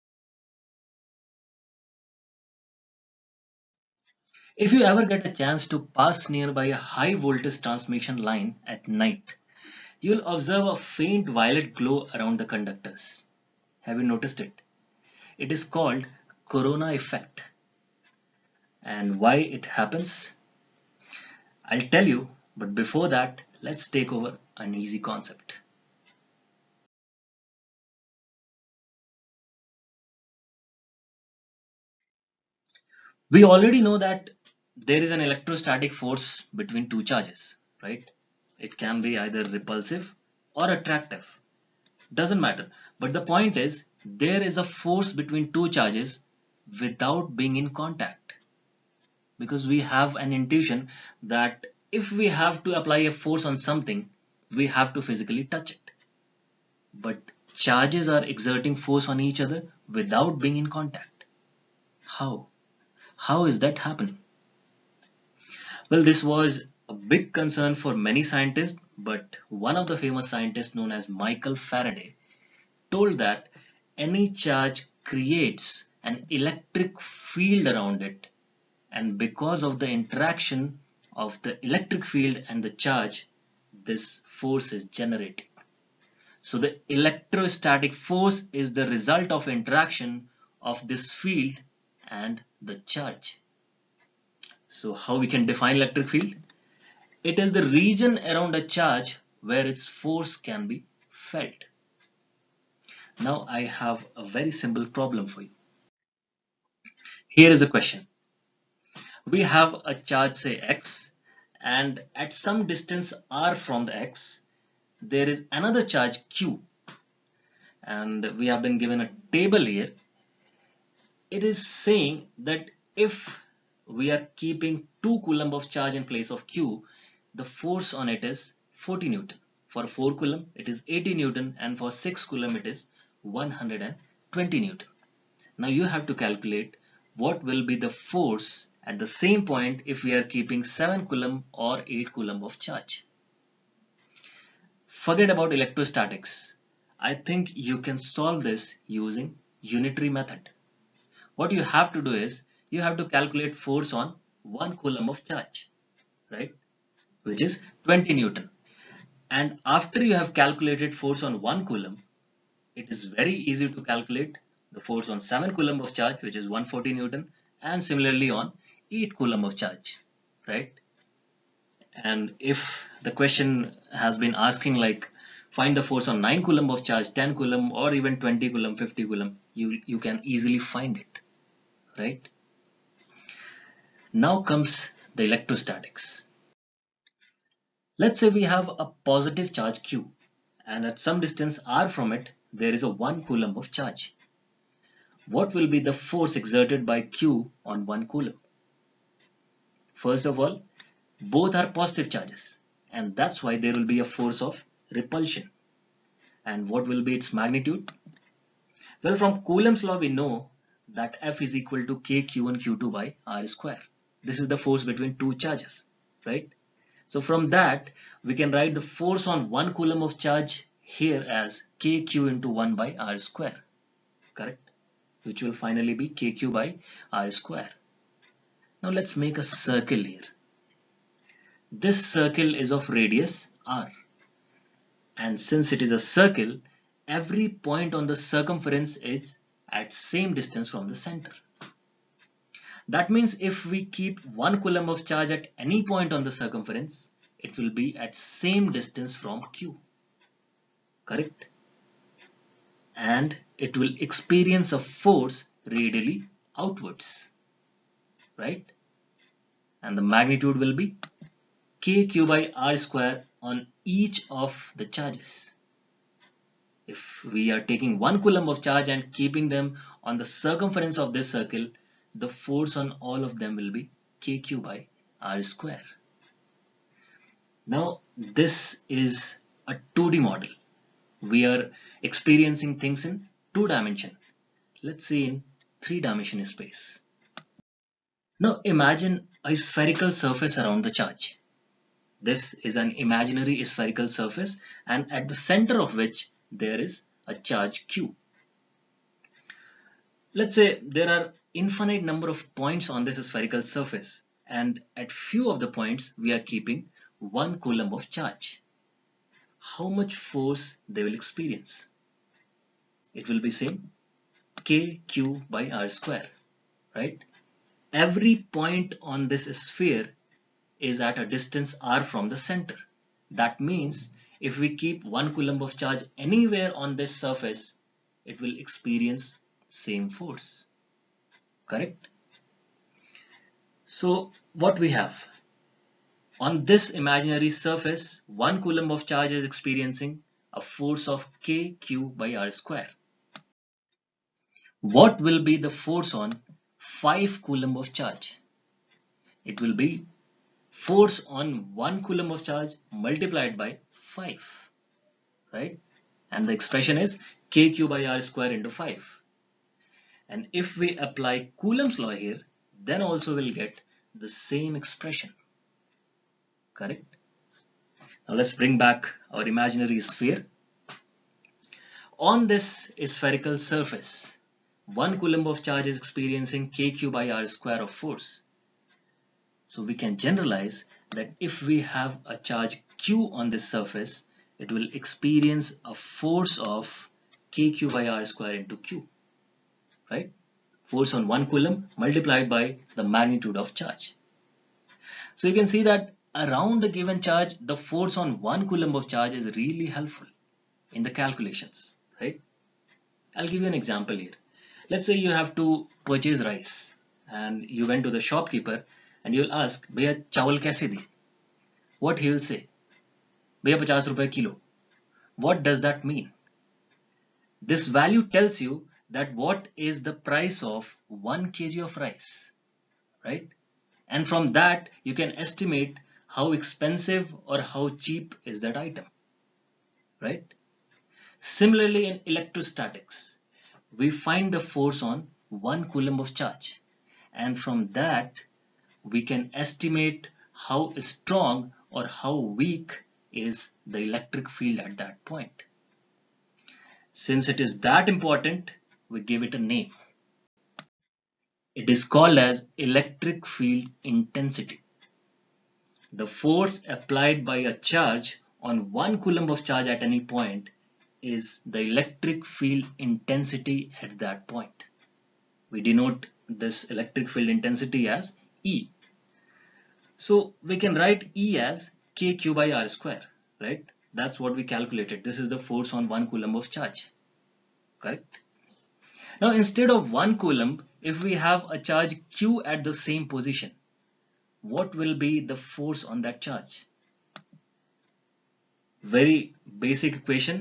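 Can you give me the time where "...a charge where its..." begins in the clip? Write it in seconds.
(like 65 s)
98 s.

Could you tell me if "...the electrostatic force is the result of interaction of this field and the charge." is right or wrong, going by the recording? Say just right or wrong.
right.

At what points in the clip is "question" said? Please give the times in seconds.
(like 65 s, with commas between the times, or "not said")
107 s, 173 s.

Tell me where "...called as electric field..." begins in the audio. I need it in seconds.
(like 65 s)
452 s.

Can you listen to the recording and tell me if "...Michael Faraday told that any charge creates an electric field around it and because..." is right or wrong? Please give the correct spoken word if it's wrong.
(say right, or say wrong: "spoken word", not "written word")
right.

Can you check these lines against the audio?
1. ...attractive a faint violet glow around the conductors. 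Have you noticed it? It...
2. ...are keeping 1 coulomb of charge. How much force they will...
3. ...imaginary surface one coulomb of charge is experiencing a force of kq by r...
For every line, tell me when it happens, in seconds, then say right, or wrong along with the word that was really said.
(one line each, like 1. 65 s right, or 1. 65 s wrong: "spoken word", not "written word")
1. 10 s wrong: "observe", not "attractive"
2. 306 s right
3. 337 s right.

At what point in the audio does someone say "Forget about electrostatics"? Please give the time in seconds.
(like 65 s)
144 s.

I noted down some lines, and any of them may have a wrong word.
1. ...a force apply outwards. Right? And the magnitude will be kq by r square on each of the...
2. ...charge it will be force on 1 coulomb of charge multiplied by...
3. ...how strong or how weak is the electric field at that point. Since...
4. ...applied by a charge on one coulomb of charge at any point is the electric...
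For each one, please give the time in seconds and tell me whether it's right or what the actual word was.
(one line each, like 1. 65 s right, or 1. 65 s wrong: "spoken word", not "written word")
1. 254 s wrong: "radially", not "apply"
2. 347 s right
3. 440 s right
4. 456 s right.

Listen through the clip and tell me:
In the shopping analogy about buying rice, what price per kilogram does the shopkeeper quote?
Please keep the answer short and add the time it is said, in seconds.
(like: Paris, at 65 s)
50 rupees, at 413 s.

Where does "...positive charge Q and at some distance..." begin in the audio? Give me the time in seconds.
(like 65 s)
189 s.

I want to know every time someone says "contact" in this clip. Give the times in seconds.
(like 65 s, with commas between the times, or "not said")
47 s, 60 s.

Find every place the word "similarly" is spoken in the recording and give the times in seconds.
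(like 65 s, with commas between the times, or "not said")
167 s, 431 s.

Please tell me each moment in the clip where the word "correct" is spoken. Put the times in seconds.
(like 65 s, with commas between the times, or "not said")
224 s, 251 s, 331 s, 366 s, 477 s.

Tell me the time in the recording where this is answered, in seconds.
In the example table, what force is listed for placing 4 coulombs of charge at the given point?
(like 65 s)
130 s.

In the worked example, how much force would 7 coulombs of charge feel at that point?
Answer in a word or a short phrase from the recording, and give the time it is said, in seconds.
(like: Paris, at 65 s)
140 newtons, at 166 s.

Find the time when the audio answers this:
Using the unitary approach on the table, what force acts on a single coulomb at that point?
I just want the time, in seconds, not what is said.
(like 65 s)
157 s.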